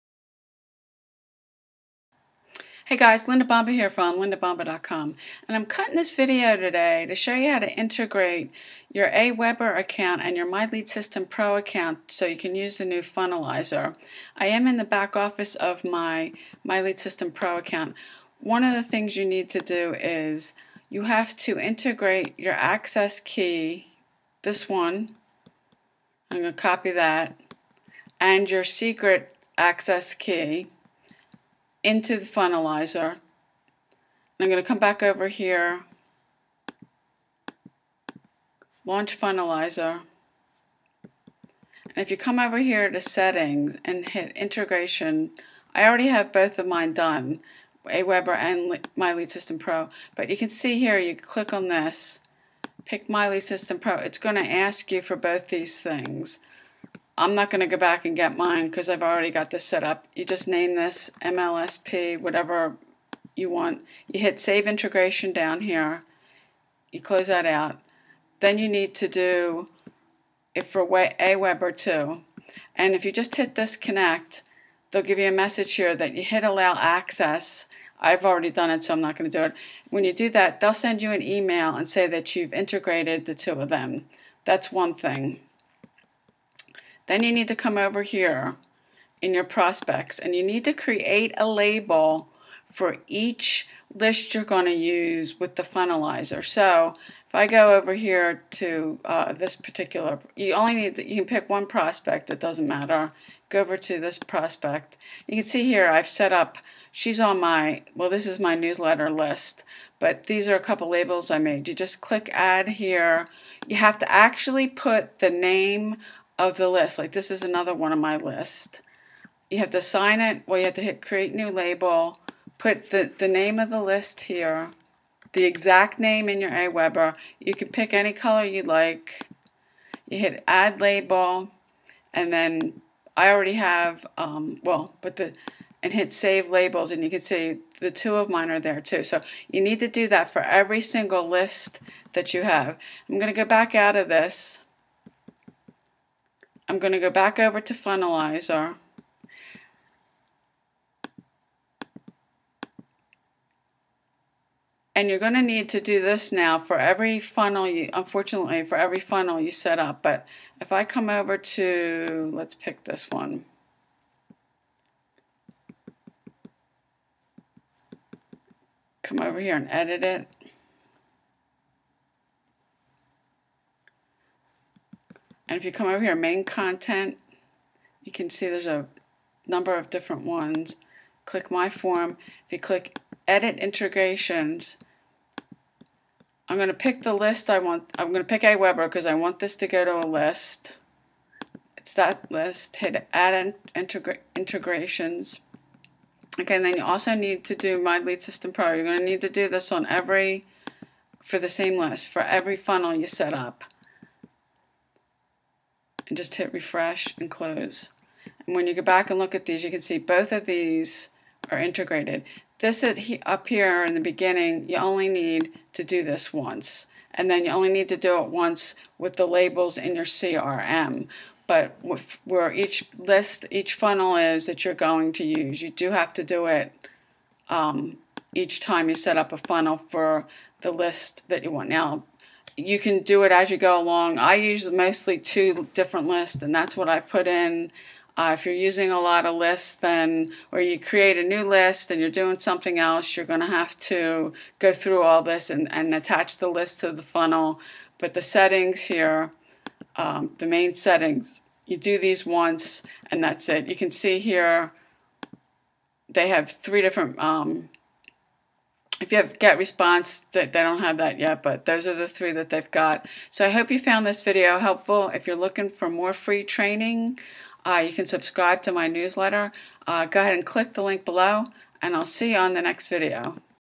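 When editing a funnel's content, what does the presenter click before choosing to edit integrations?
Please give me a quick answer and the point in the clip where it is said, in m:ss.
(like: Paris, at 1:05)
My Form, at 3:01.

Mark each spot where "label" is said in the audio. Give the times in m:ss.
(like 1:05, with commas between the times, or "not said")
1:31, 1:50, 2:01, 2:10, 2:16, 3:39.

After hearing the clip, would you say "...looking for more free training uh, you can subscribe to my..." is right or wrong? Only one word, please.
right.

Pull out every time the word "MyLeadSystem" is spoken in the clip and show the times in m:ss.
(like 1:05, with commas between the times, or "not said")
0:10, 0:16.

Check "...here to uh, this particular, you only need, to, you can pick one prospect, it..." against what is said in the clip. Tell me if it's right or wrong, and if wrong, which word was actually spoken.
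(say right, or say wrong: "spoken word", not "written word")
right.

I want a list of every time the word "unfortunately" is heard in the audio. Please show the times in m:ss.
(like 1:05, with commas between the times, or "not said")
2:37.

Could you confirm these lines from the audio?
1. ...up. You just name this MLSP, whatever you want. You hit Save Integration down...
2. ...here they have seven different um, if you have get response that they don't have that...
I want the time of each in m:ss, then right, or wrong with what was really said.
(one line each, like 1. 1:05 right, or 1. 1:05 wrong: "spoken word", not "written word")
1. 0:59 right
2. 4:14 wrong: "three", not "seven".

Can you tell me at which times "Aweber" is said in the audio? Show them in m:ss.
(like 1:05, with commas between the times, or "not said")
0:09, 0:47, 2:06, 3:08.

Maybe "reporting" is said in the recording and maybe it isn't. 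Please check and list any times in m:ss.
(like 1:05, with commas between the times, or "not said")
not said.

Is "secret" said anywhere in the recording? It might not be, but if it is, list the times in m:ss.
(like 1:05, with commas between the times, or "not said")
0:28.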